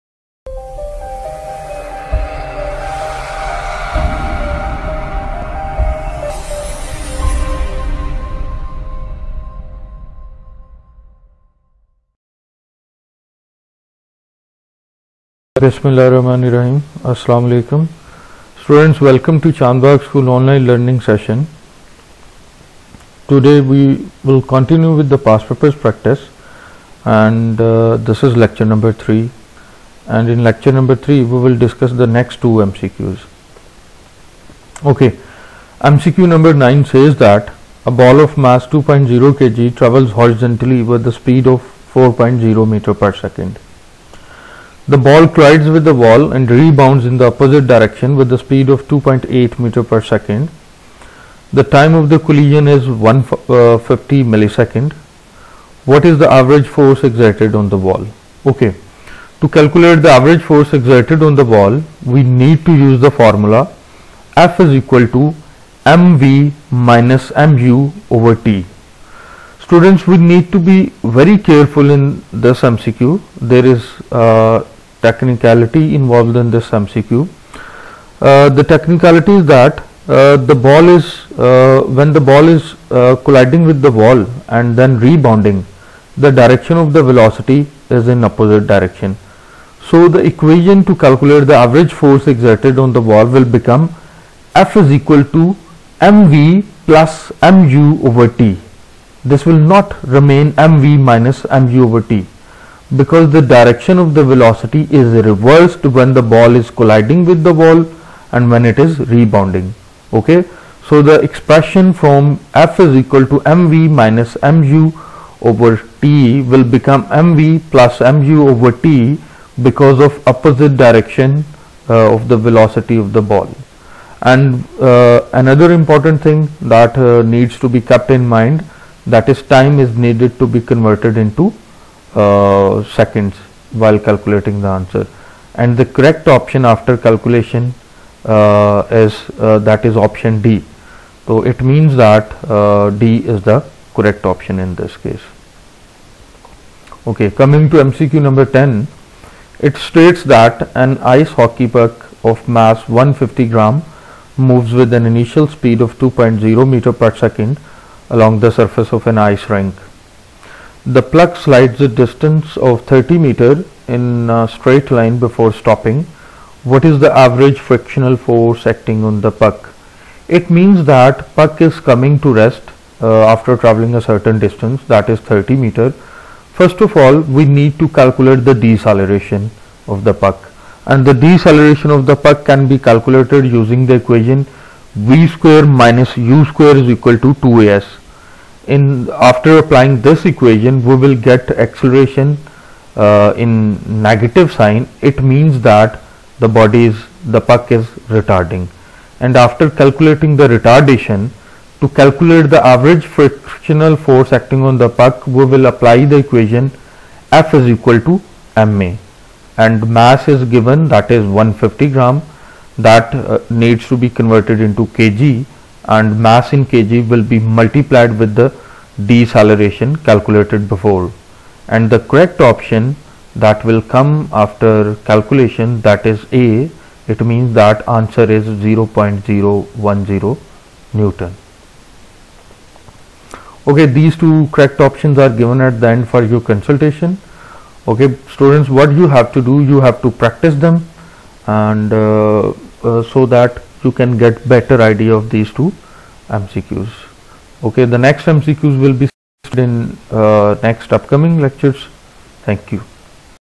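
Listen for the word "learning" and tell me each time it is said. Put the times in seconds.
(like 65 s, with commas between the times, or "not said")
20 s.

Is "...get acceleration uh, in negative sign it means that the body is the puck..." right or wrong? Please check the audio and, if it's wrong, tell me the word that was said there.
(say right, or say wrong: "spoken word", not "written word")
right.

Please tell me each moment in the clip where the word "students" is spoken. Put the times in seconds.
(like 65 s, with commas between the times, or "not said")
18 s, 69 s, 238 s.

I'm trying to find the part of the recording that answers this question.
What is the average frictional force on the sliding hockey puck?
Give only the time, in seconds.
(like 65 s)
228 s.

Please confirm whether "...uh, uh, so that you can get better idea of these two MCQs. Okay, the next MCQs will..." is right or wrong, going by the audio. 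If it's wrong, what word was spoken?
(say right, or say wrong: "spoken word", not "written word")
right.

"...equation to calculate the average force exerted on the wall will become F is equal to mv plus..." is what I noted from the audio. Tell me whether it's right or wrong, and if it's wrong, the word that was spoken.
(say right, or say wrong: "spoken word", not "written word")
right.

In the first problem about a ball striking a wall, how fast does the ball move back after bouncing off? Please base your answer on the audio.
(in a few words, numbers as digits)
2.8 meters per second.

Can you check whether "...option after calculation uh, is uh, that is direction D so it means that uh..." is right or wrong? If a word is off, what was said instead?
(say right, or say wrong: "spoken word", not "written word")
wrong: "option", not "direction".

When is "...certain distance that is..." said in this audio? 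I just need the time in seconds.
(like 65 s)
174 s.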